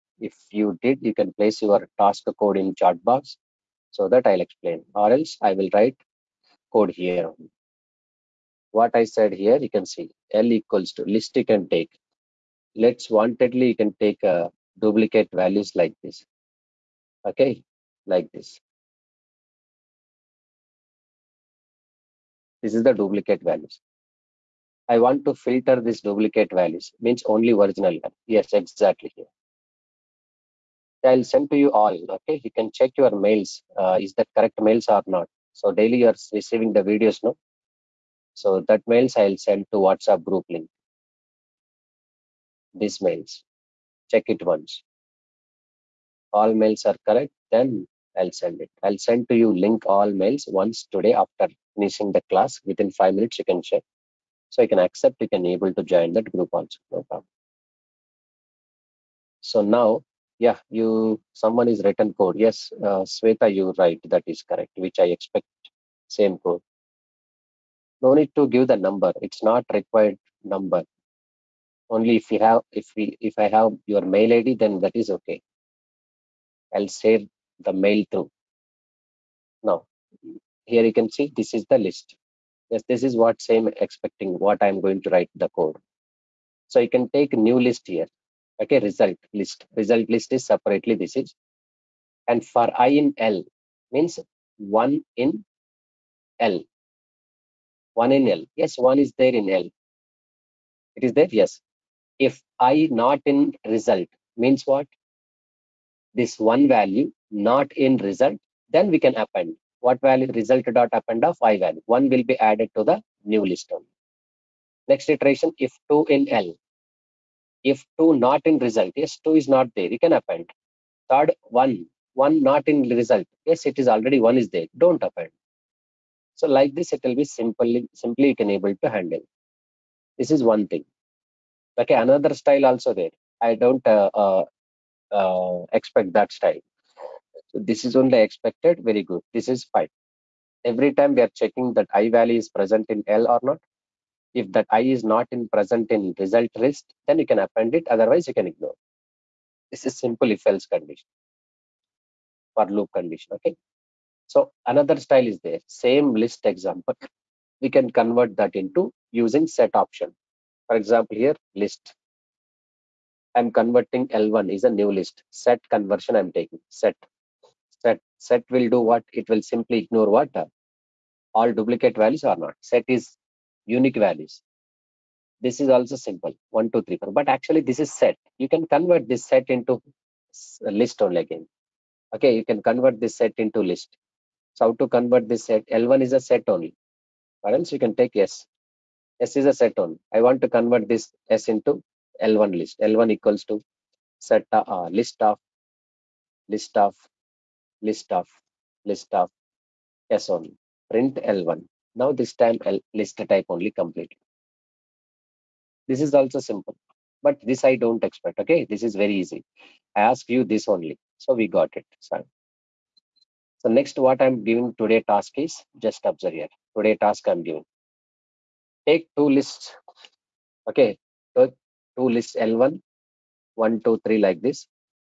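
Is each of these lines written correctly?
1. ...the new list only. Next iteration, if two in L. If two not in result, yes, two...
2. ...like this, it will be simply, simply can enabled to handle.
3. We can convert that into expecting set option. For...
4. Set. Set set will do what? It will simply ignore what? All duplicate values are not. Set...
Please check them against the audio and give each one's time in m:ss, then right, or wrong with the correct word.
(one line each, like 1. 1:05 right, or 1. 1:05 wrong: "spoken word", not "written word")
1. 1:52 right
2. 2:06 right
3. 2:37 wrong: "using", not "expecting"
4. 2:46 right.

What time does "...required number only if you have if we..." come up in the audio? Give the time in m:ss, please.
1:09.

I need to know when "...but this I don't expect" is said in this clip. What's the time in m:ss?
3:27.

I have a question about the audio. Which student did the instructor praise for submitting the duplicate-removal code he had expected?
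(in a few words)
Sweta.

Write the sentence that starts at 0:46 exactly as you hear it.
All mails are correct, then I'll send it.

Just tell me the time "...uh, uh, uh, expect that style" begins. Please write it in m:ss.
2:13.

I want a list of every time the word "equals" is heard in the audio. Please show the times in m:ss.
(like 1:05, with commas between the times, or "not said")
0:10, 3:13.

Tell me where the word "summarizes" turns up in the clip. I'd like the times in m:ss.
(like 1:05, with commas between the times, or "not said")
not said.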